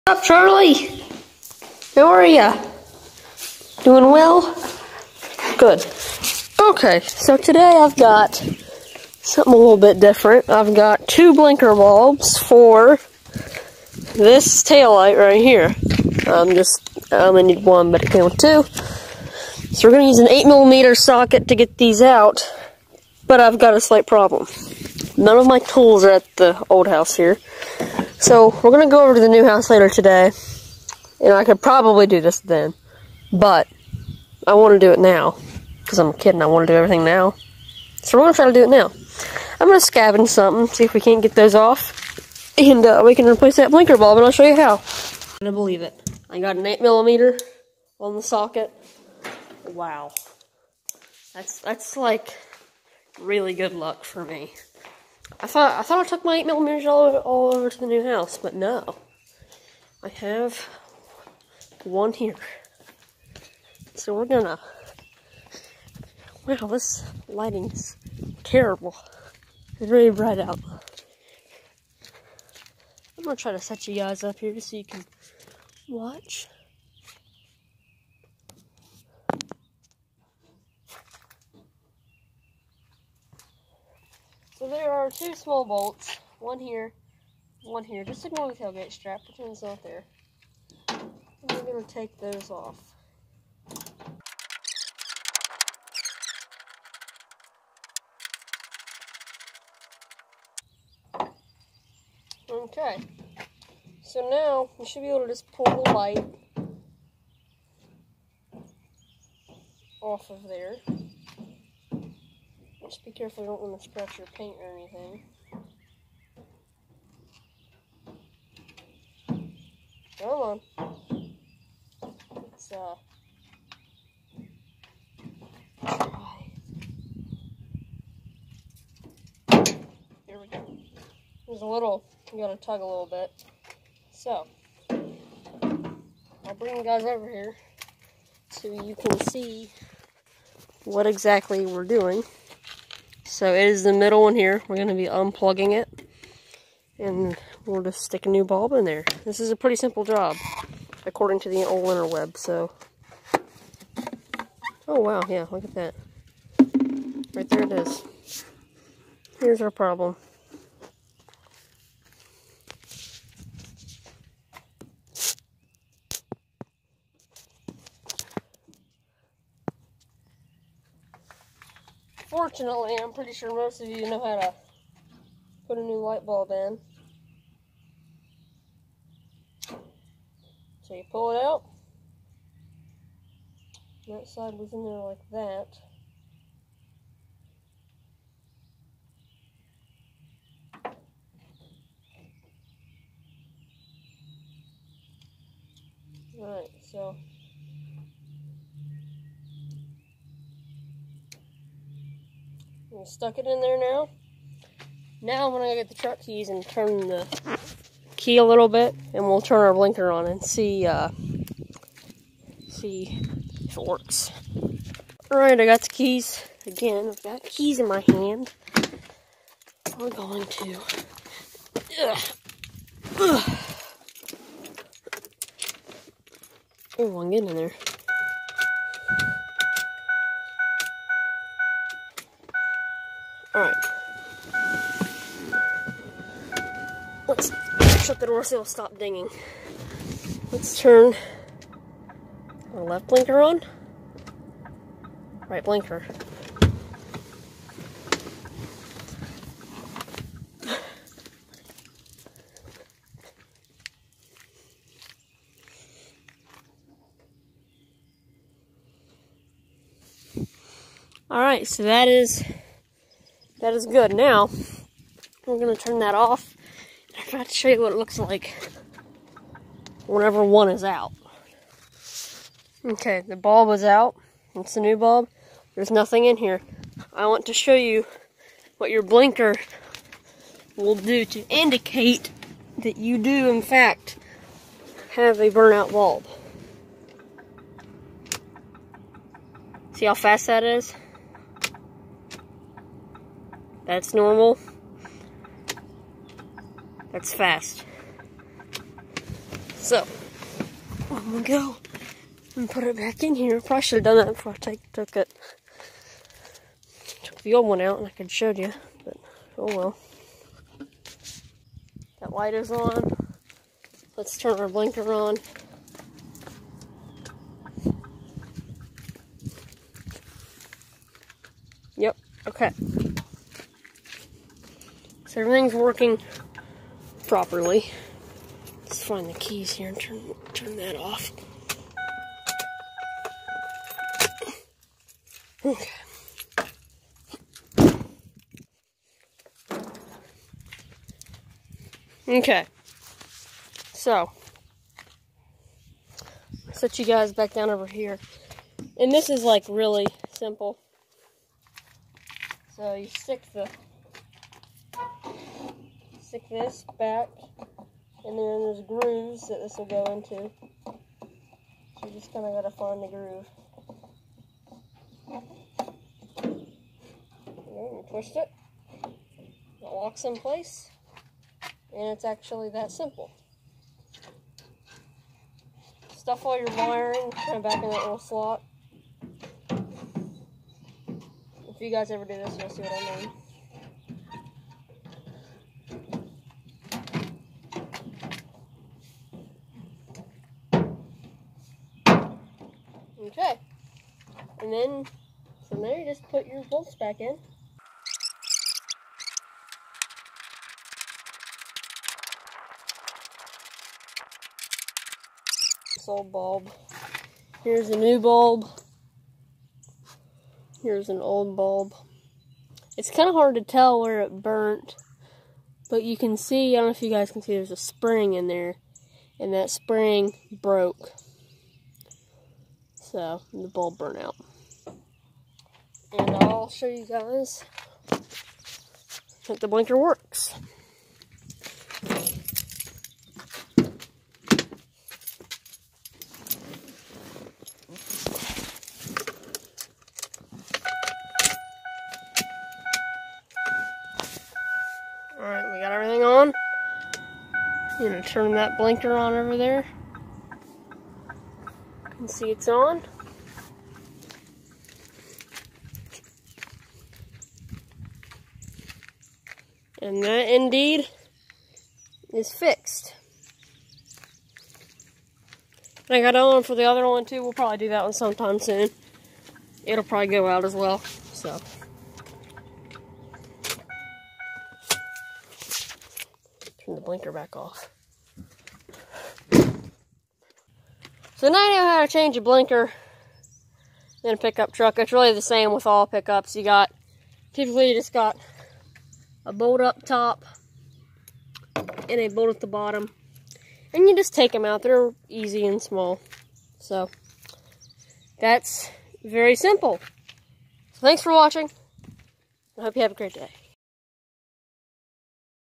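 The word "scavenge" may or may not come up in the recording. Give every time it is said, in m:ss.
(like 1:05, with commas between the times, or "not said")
0:39.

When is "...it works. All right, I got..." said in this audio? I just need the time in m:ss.
3:33.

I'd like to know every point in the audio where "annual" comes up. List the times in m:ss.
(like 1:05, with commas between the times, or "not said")
not said.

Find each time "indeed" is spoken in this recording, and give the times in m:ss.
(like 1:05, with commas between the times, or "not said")
7:40.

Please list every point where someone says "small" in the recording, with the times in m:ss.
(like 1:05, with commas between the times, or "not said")
1:25, 8:15.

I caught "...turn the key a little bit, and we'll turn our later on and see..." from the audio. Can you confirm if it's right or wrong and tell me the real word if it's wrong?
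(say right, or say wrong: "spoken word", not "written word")
wrong: "blinker", not "later".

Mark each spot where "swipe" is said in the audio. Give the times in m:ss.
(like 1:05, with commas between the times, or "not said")
not said.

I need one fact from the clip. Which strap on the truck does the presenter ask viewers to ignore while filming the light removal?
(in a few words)
tailgate strap.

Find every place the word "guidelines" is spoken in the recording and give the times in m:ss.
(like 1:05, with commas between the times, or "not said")
not said.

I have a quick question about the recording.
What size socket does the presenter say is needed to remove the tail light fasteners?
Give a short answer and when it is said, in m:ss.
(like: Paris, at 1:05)
8mm, at 0:20.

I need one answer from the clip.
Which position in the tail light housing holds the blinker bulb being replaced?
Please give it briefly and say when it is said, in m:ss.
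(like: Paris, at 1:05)
middle, at 2:23.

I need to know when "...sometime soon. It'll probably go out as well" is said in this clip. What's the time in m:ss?
7:48.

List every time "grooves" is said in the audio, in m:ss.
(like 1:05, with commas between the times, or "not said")
5:58, 6:03.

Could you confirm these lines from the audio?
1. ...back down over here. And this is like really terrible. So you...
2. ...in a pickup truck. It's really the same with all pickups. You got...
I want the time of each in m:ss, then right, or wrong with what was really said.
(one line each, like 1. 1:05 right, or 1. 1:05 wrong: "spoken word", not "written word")
1. 5:47 wrong: "simple", not "terrible"
2. 8:04 right.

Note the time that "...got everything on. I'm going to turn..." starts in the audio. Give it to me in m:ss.
7:25.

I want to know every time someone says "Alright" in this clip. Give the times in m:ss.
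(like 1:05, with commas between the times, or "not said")
3:16, 7:25.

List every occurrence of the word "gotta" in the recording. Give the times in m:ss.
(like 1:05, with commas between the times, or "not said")
2:12.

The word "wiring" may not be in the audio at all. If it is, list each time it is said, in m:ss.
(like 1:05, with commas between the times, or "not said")
6:16.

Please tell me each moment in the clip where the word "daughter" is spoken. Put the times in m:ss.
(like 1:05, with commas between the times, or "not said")
not said.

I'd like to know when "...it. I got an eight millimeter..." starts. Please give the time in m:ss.
0:45.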